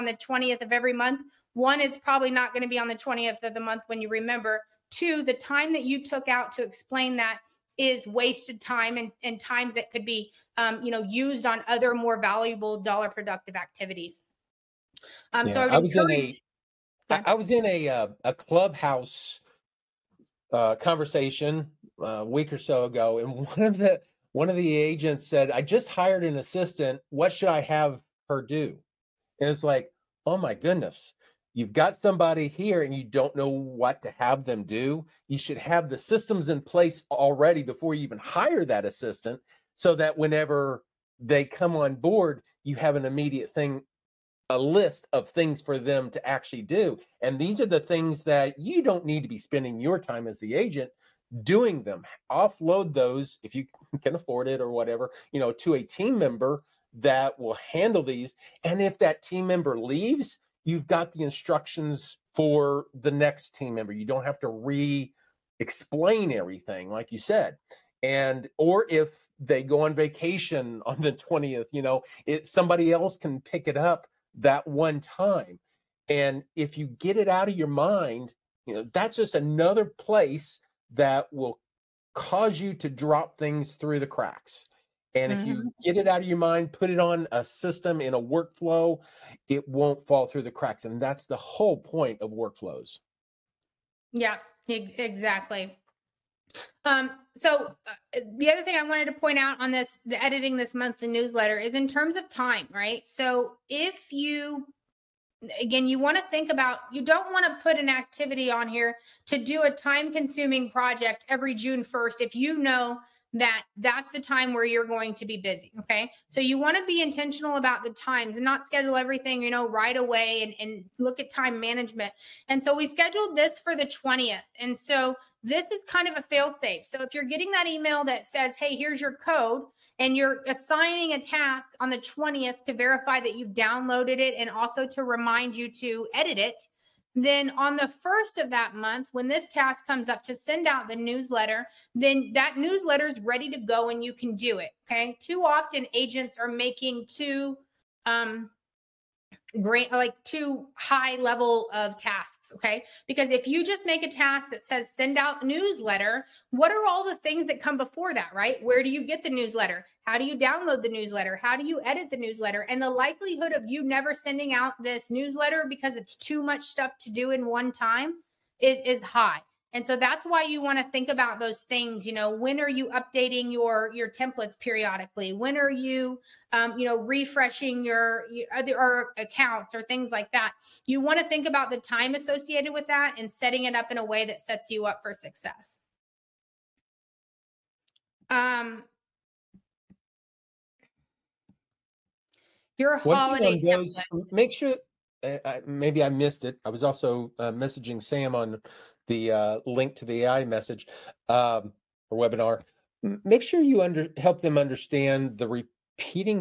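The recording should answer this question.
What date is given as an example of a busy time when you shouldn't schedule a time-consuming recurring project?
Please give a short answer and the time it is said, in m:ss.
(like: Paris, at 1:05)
June 1st, at 1:51.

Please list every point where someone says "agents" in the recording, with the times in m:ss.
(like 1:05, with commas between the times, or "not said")
0:24, 0:50, 2:25.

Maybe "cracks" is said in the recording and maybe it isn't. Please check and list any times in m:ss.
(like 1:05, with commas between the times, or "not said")
1:24, 1:30.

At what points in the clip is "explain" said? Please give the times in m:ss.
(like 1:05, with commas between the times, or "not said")
0:06, 1:05.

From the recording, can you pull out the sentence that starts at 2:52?
You know, when are you updating your your templates periodically?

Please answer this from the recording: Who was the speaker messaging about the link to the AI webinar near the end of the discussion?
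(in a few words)
Sam.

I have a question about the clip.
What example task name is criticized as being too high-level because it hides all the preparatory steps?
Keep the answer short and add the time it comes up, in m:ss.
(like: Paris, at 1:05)
send out newsletter, at 2:34.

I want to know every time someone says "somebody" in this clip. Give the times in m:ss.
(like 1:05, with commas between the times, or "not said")
0:31, 1:12.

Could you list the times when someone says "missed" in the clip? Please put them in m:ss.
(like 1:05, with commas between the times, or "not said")
3:16.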